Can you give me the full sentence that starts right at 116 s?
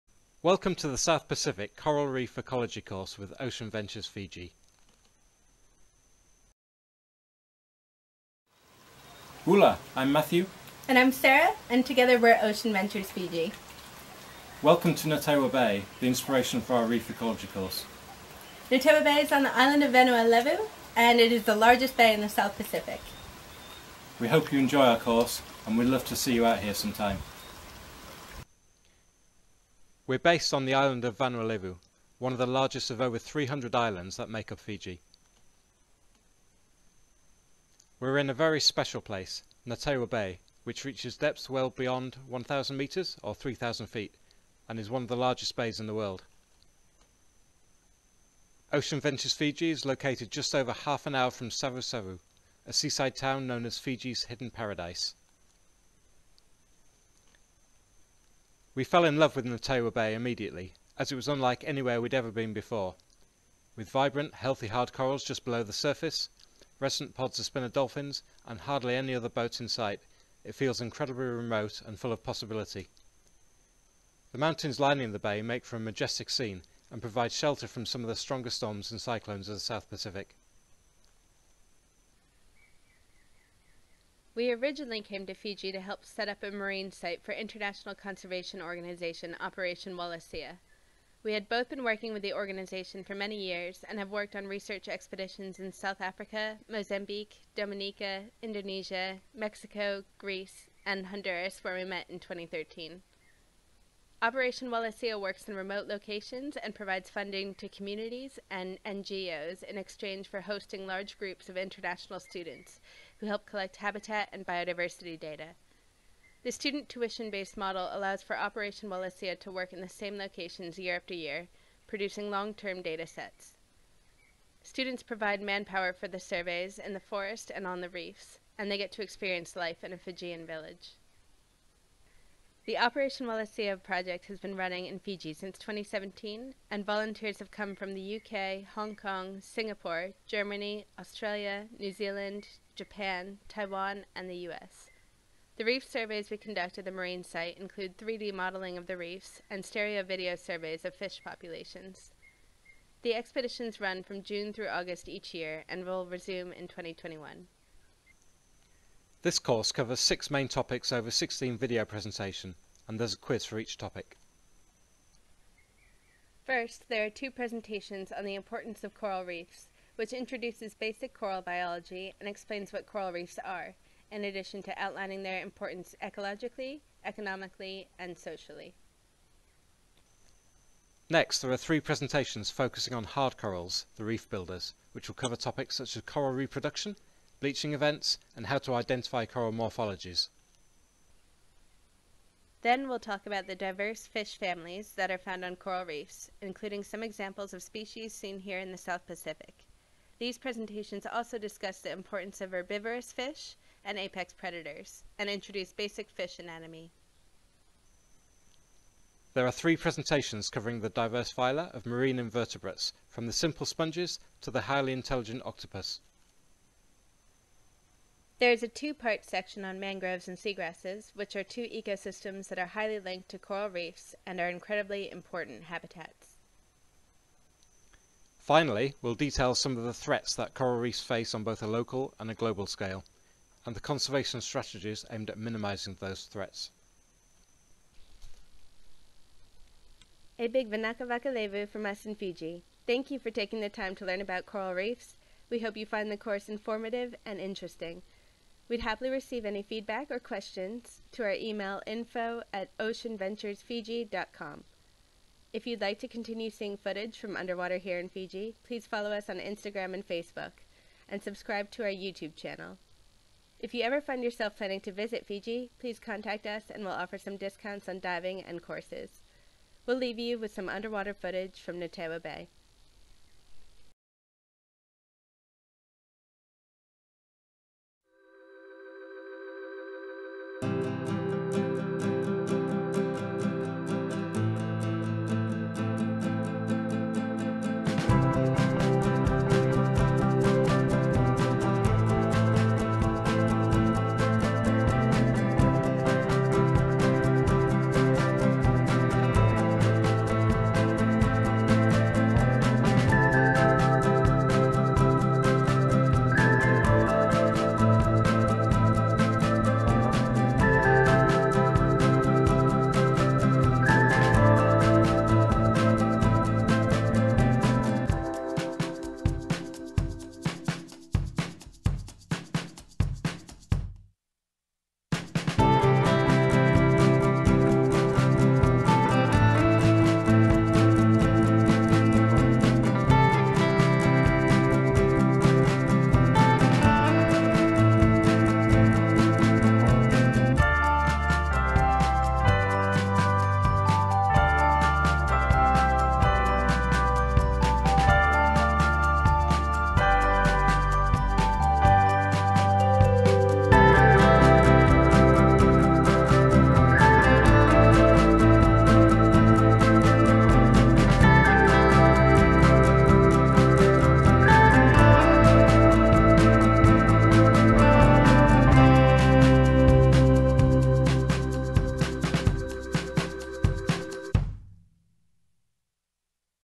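The student tuition-based model allows for Operation Wallacea to work in the same locations year after year, producing long-term data sets.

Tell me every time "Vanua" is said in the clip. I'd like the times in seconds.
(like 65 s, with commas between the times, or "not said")
19 s, 31 s.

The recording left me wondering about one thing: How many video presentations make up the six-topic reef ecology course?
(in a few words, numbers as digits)
16.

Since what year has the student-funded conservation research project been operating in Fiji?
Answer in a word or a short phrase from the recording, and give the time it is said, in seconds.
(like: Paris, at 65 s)
2017, at 135 s.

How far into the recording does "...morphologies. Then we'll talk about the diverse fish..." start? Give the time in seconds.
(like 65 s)
189 s.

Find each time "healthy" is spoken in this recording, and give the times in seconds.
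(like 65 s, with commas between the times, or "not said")
64 s.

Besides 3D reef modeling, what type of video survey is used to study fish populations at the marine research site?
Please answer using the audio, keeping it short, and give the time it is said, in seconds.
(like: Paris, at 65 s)
Stereo video, at 149 s.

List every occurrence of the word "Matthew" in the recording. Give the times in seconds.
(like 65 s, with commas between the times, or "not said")
10 s.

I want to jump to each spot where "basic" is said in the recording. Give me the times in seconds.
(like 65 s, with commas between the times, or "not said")
170 s, 205 s.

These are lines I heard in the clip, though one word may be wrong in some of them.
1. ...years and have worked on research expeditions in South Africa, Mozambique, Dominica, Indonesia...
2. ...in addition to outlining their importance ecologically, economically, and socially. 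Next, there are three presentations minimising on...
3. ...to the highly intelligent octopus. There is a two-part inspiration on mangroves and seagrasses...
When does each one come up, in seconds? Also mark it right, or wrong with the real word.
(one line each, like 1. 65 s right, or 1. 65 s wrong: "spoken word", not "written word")
1. 93 s right
2. 174 s wrong: "focusing", not "minimising"
3. 214 s wrong: "section", not "inspiration".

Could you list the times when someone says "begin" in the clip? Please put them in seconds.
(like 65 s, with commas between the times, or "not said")
not said.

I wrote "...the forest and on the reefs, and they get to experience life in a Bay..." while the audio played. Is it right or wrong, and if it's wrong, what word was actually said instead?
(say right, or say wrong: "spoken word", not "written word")
wrong: "Fijian", not "Bay".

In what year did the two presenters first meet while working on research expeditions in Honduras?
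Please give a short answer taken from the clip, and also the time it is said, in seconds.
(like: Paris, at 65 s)
2013, at 102 s.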